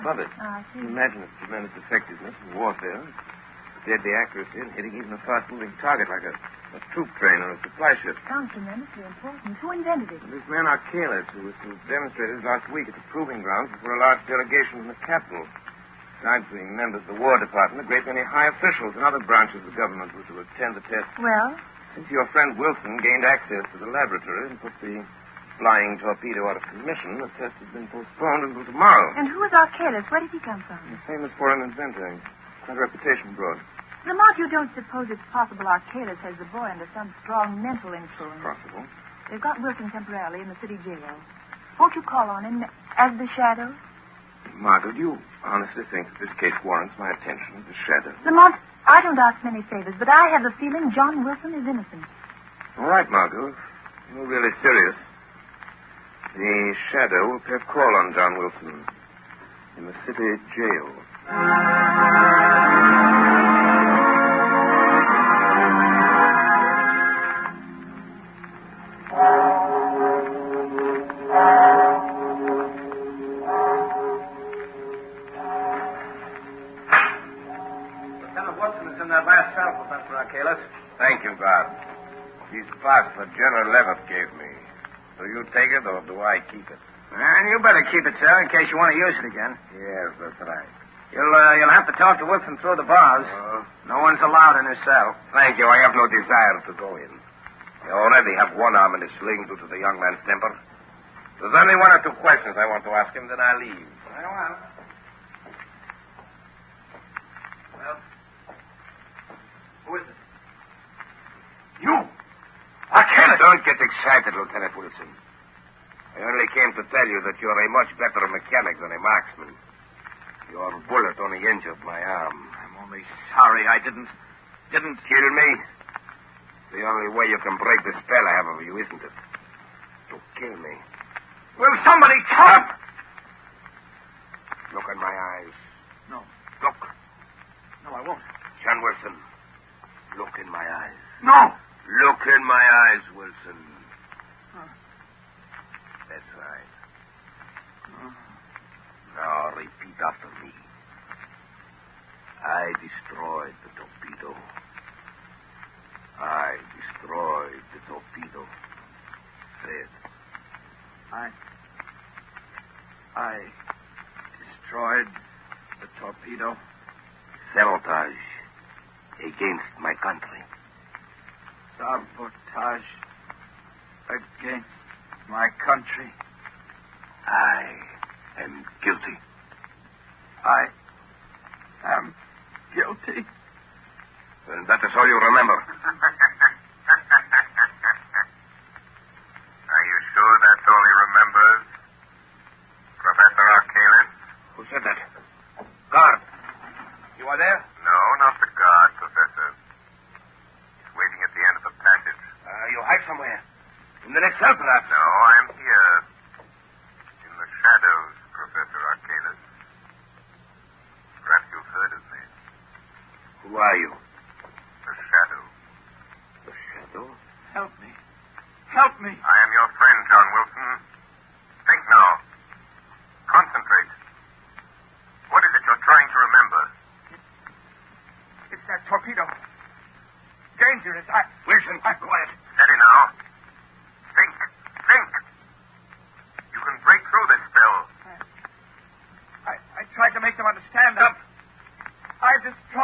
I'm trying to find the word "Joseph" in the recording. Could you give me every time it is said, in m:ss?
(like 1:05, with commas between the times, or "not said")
not said.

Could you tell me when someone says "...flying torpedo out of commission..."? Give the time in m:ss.
0:25.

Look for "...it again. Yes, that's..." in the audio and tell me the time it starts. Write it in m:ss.
1:29.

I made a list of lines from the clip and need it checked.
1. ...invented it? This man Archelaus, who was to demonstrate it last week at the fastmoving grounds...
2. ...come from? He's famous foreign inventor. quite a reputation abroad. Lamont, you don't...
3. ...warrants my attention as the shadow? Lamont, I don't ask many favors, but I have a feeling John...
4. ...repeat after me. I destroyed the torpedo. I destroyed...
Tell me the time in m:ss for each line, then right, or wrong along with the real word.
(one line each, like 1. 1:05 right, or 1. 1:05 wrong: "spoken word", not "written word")
1. 0:09 wrong: "proving", not "fastmoving"
2. 0:30 right
3. 0:46 right
4. 2:29 right.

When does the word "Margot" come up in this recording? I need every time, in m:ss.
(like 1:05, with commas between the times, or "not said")
0:44, 0:53.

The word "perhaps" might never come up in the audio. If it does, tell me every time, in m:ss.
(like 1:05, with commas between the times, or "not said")
3:24, 3:31.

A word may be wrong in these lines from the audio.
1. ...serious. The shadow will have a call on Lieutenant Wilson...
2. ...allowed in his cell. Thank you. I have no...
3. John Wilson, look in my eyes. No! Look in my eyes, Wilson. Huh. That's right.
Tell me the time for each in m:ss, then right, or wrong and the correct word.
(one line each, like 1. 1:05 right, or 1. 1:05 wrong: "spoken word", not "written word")
1. 0:54 wrong: "John", not "Lieutenant"
2. 1:34 right
3. 2:18 right.